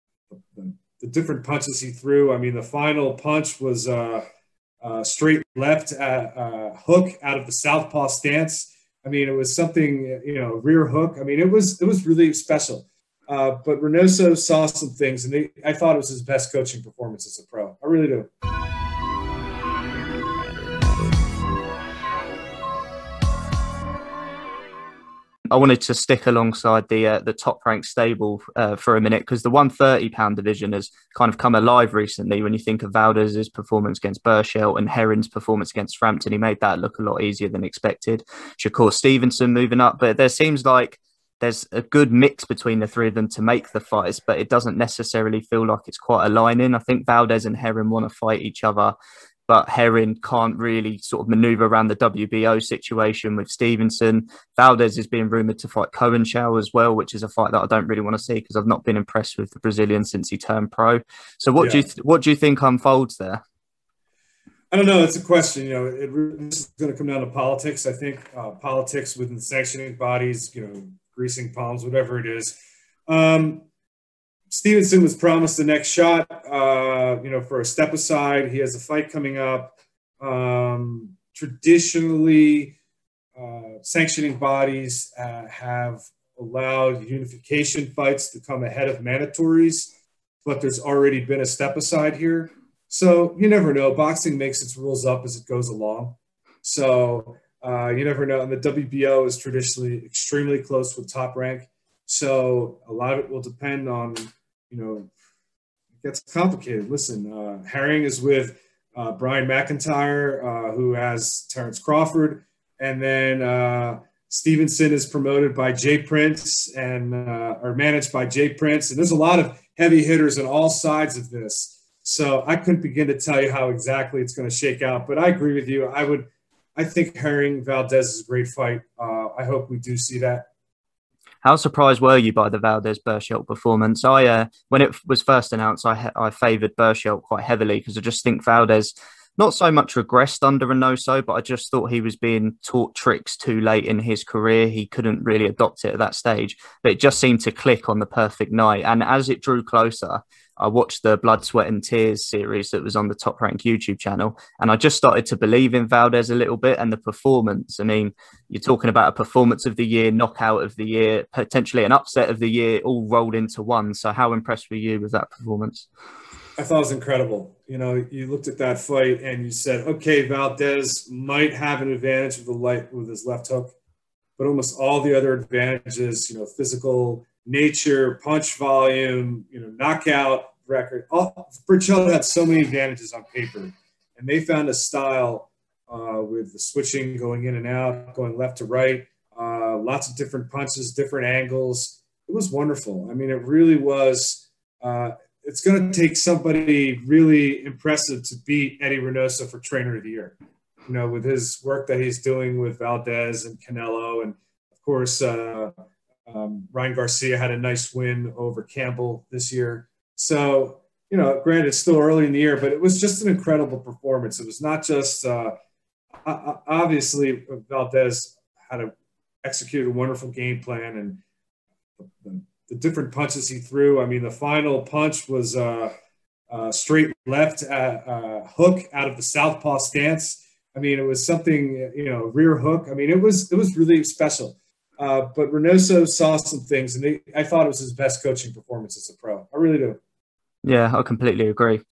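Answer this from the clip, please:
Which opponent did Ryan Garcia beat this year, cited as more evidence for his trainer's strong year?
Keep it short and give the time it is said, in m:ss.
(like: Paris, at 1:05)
Campbell, at 3:28.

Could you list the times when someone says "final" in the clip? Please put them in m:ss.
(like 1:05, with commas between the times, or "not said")
0:02, 3:44.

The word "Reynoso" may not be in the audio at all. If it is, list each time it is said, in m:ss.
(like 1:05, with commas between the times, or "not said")
0:13, 2:20, 3:18, 3:55.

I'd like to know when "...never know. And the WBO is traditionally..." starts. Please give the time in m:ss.
1:38.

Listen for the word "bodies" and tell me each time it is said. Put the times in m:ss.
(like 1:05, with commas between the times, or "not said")
1:09, 1:24.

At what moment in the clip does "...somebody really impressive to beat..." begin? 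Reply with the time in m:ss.
3:16.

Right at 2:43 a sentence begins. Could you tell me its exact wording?
So, how impressed were you with that performance?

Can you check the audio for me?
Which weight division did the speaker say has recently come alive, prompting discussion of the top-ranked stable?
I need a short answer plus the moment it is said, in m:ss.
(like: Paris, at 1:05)
130 pound, at 0:29.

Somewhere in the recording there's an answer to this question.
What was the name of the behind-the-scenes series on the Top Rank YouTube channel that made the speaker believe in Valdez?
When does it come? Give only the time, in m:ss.
2:31.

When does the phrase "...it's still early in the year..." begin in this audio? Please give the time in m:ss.
3:31.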